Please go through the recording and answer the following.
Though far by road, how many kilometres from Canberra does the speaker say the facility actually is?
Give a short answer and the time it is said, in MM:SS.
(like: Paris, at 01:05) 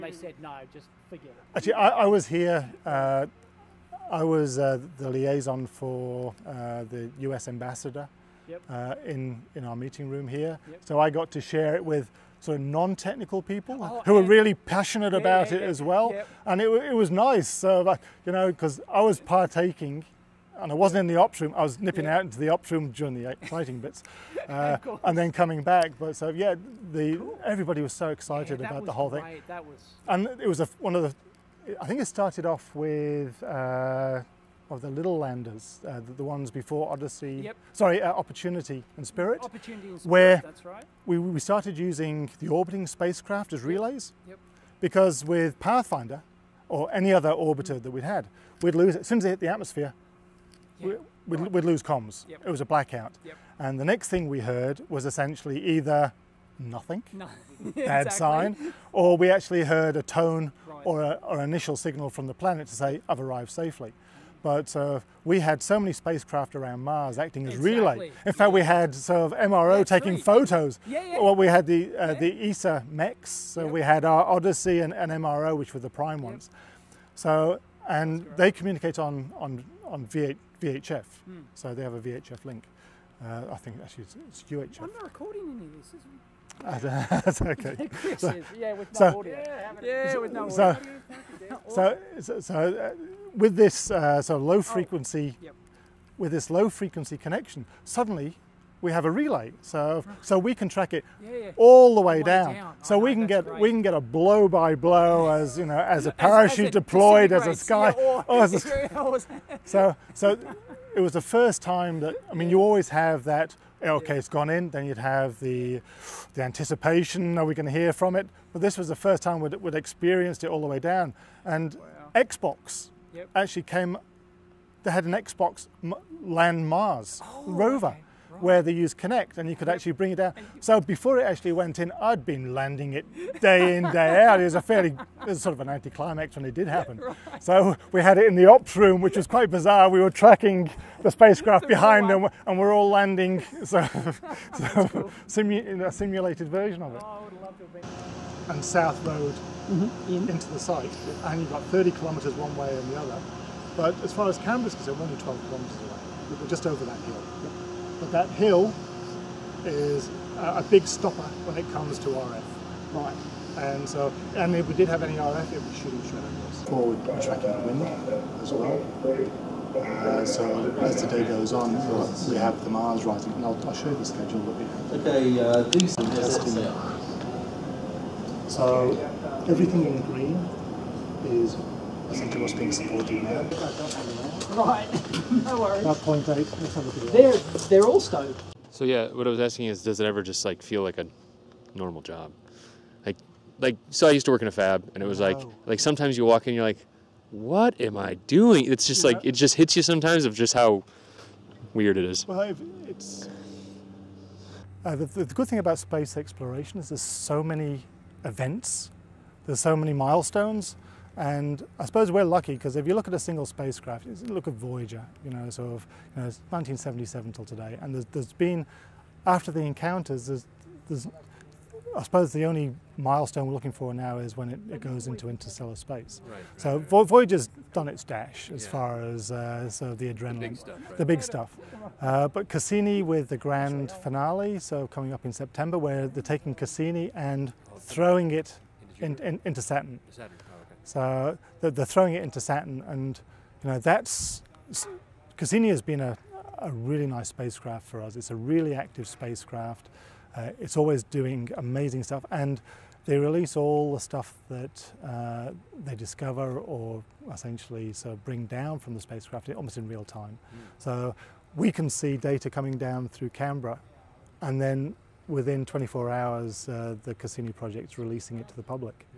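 12, at 02:35.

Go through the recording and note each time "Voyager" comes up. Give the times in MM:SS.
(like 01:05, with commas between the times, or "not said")
03:34, 03:47.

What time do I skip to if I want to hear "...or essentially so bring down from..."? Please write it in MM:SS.
04:16.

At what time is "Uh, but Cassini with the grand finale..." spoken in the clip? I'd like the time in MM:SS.
03:52.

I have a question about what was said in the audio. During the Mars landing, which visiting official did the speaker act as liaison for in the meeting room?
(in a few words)
US ambassador.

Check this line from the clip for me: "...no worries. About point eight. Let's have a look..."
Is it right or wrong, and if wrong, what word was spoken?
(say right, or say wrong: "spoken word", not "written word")
right.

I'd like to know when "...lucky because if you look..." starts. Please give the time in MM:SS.
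03:32.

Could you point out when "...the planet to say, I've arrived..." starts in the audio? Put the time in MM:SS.
01:02.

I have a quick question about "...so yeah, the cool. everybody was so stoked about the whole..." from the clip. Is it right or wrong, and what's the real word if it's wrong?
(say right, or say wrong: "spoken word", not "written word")
wrong: "excited", not "stoked".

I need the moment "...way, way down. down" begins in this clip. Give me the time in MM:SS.
01:42.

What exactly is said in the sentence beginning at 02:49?
Uh, so as the day goes on, we have the Mars rising, and I'll, I'll show you the schedule that we have.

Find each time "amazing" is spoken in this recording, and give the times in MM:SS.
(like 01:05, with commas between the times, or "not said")
04:11.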